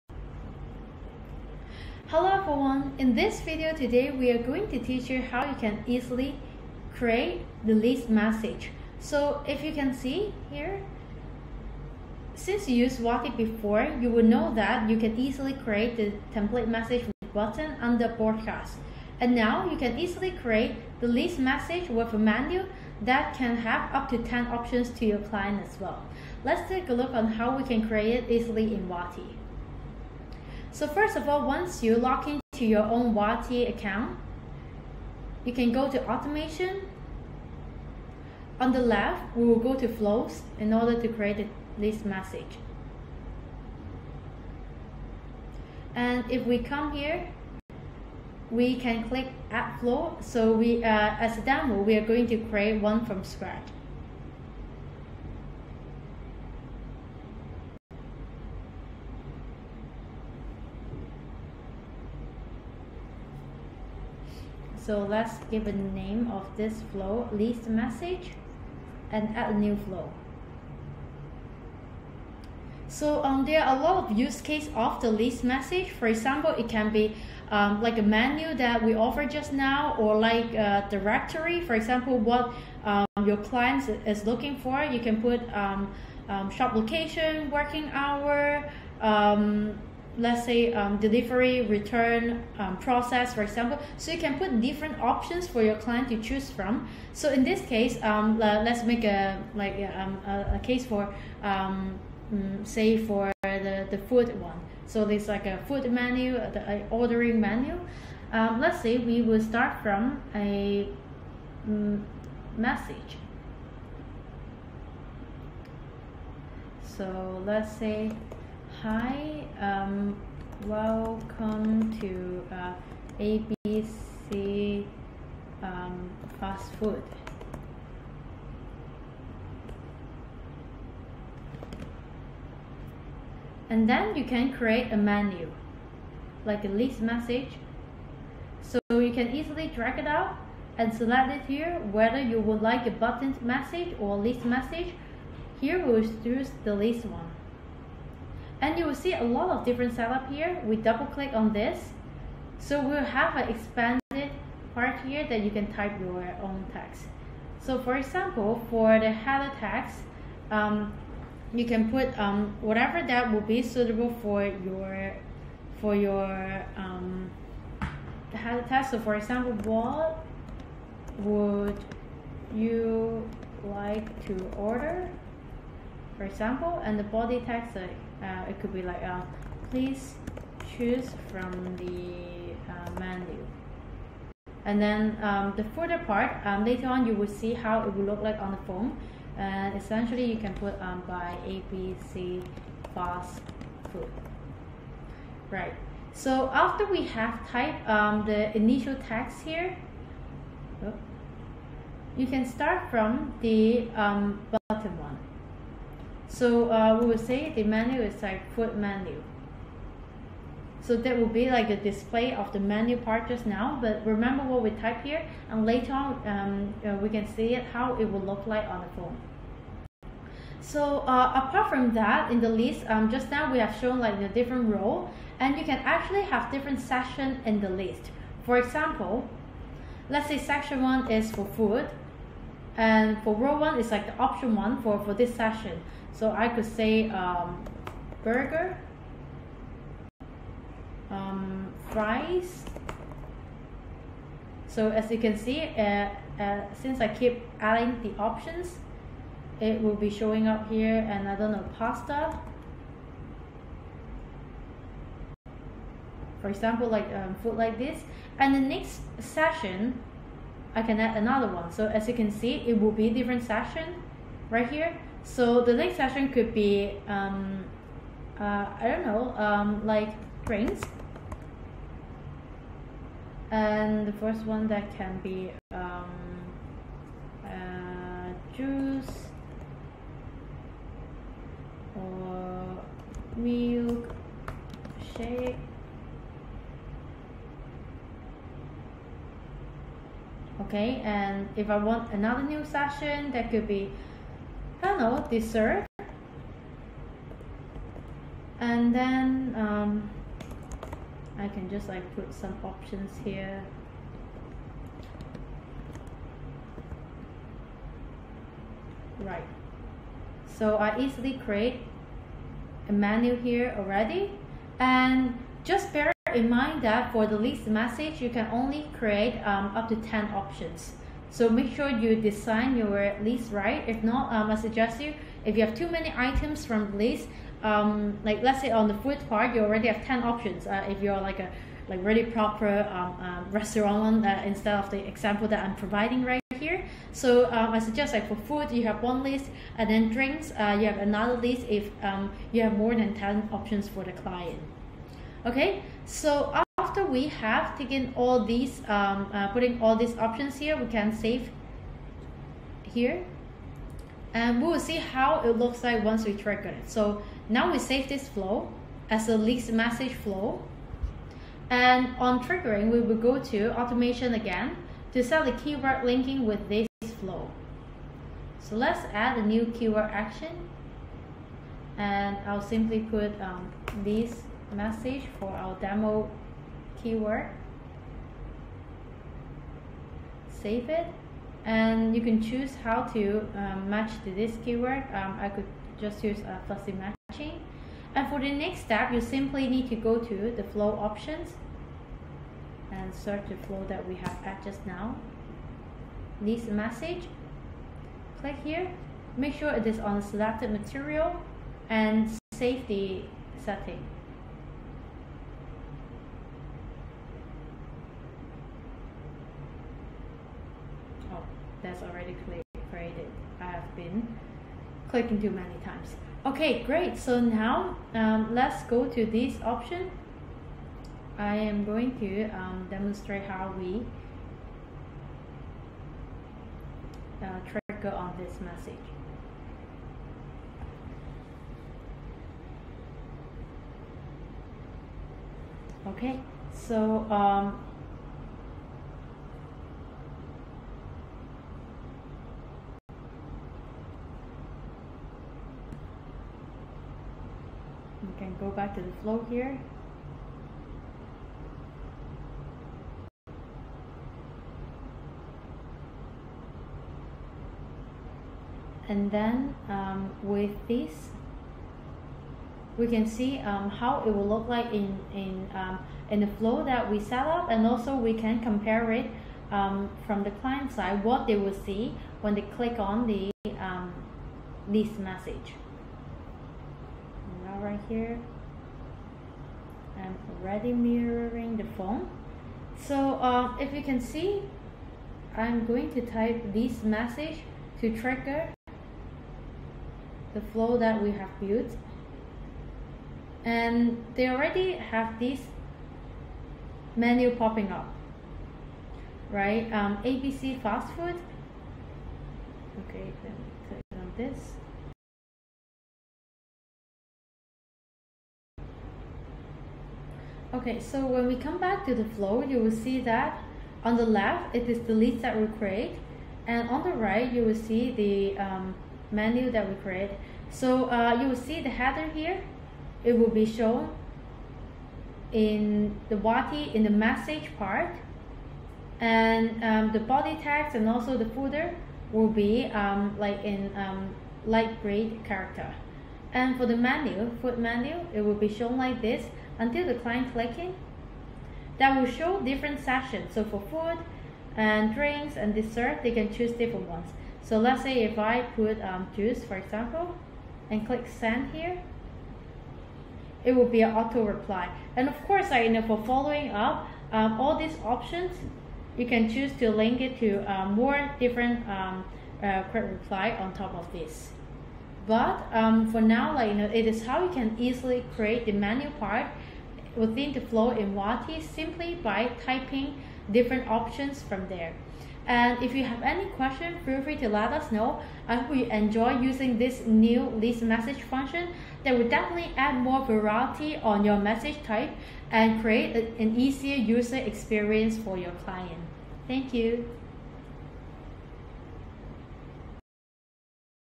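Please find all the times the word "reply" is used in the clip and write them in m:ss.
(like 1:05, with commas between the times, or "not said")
9:14, 9:23.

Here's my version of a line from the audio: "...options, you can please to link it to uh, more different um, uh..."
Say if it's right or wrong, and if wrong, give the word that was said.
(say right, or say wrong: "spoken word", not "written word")
wrong: "choose", not "please".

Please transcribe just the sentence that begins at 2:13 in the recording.
And then you can create a menu, like a list message.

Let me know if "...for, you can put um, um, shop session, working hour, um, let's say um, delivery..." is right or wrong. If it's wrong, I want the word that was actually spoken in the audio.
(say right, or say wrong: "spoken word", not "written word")
wrong: "location", not "session".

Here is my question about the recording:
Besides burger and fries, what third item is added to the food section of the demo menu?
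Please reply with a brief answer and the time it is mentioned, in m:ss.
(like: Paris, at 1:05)
pasta, at 4:11.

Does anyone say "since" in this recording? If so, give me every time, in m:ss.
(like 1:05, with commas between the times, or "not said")
0:12, 4:06.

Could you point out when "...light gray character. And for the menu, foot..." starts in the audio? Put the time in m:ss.
8:54.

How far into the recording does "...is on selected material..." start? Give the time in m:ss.
6:39.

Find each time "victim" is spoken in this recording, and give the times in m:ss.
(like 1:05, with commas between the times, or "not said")
not said.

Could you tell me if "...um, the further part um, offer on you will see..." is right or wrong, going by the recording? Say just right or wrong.
wrong.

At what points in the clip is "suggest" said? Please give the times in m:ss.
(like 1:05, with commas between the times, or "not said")
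5:24, 5:37.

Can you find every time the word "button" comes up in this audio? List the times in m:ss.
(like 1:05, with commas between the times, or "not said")
0:17, 2:22.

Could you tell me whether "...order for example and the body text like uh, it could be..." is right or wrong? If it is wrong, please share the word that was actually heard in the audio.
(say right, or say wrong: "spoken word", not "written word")
right.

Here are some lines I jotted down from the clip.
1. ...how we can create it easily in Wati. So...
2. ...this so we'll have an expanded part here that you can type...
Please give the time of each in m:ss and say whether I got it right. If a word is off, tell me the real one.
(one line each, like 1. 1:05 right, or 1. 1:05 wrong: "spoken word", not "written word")
1. 0:27 right
2. 2:31 right.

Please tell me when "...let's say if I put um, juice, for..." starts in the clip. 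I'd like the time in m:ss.
9:07.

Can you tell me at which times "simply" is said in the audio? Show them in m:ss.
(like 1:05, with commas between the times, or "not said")
6:12, 6:29, 9:31.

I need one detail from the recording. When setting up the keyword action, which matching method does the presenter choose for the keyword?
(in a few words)
fuzzy matching.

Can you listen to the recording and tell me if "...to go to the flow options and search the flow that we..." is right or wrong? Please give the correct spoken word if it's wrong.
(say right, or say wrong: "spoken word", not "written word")
right.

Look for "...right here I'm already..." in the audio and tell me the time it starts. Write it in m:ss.
7:57.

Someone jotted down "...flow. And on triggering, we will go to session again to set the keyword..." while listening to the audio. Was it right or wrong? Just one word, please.
wrong.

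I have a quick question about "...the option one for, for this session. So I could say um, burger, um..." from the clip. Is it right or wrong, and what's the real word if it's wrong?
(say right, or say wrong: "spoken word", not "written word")
right.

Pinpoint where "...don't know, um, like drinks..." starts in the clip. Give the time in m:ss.
4:28.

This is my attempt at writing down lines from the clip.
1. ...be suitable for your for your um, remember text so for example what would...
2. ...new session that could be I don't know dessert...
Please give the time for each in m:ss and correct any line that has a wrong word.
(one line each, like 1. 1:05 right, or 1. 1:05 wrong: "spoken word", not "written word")
1. 2:43 wrong: "header", not "remember"
2. 4:52 right.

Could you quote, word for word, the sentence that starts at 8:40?
So uh, you will see the header here.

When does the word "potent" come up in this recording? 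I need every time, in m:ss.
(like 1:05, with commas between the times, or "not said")
not said.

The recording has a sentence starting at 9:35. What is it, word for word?
And if you have any question, feel free to let us know.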